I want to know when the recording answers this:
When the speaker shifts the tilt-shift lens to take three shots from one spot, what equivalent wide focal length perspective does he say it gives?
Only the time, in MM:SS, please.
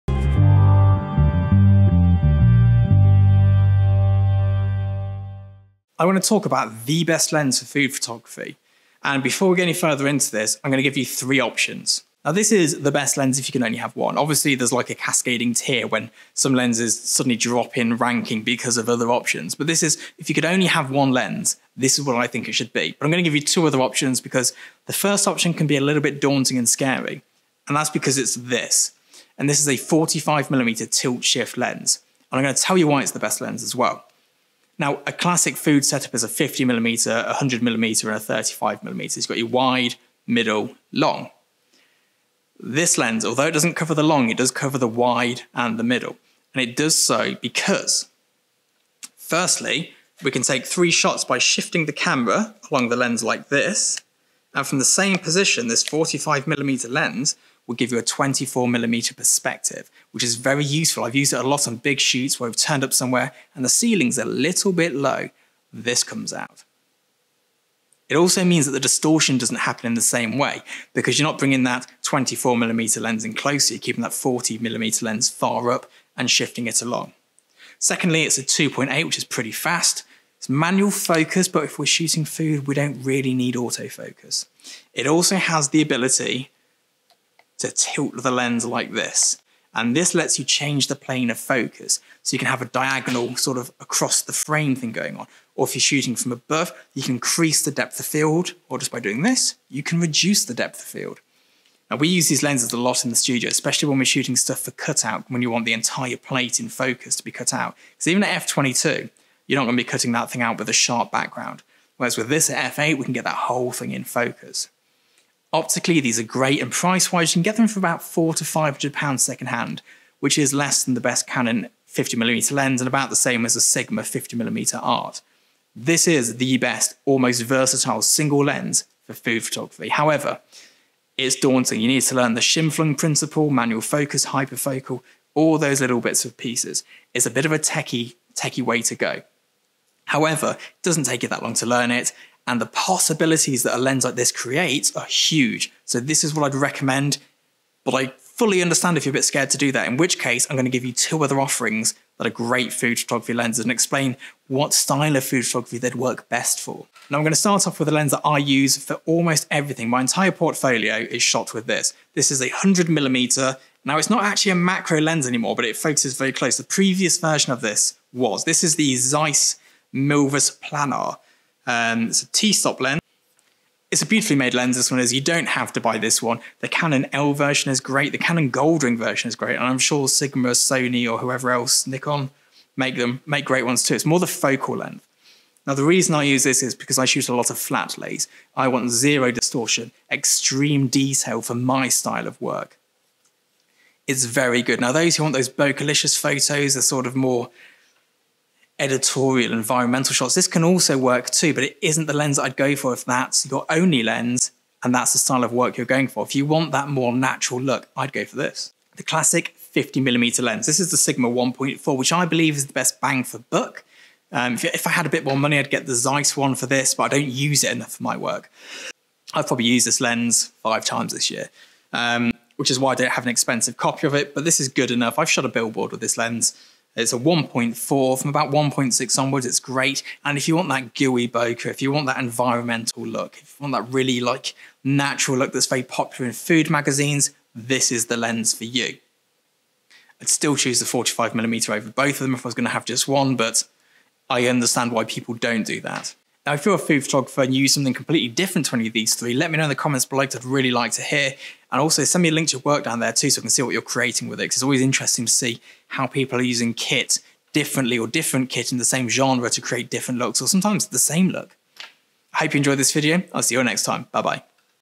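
00:58.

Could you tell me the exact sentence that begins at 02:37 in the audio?
Now I'm gonna start off with a lens that I use for almost everything.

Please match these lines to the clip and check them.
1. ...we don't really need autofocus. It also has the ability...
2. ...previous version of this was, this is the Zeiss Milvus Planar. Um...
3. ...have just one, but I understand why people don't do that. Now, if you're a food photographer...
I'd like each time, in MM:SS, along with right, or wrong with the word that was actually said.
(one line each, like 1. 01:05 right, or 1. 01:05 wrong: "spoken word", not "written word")
1. 01:22 right
2. 02:46 right
3. 04:02 right.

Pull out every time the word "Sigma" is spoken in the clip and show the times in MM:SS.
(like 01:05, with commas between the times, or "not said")
02:03, 03:00, 03:30.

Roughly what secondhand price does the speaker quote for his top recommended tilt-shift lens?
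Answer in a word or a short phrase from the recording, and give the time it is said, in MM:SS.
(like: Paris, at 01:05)
£400 to £500, at 01:58.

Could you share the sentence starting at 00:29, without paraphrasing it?
And this is a 45mm tilt shift lens.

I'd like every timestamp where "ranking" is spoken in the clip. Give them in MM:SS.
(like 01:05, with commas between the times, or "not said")
00:17.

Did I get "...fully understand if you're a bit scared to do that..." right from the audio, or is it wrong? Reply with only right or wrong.
right.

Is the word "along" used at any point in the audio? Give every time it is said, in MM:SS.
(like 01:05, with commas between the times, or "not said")
00:52, 01:16.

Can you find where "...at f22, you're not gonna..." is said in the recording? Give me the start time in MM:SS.
01:48.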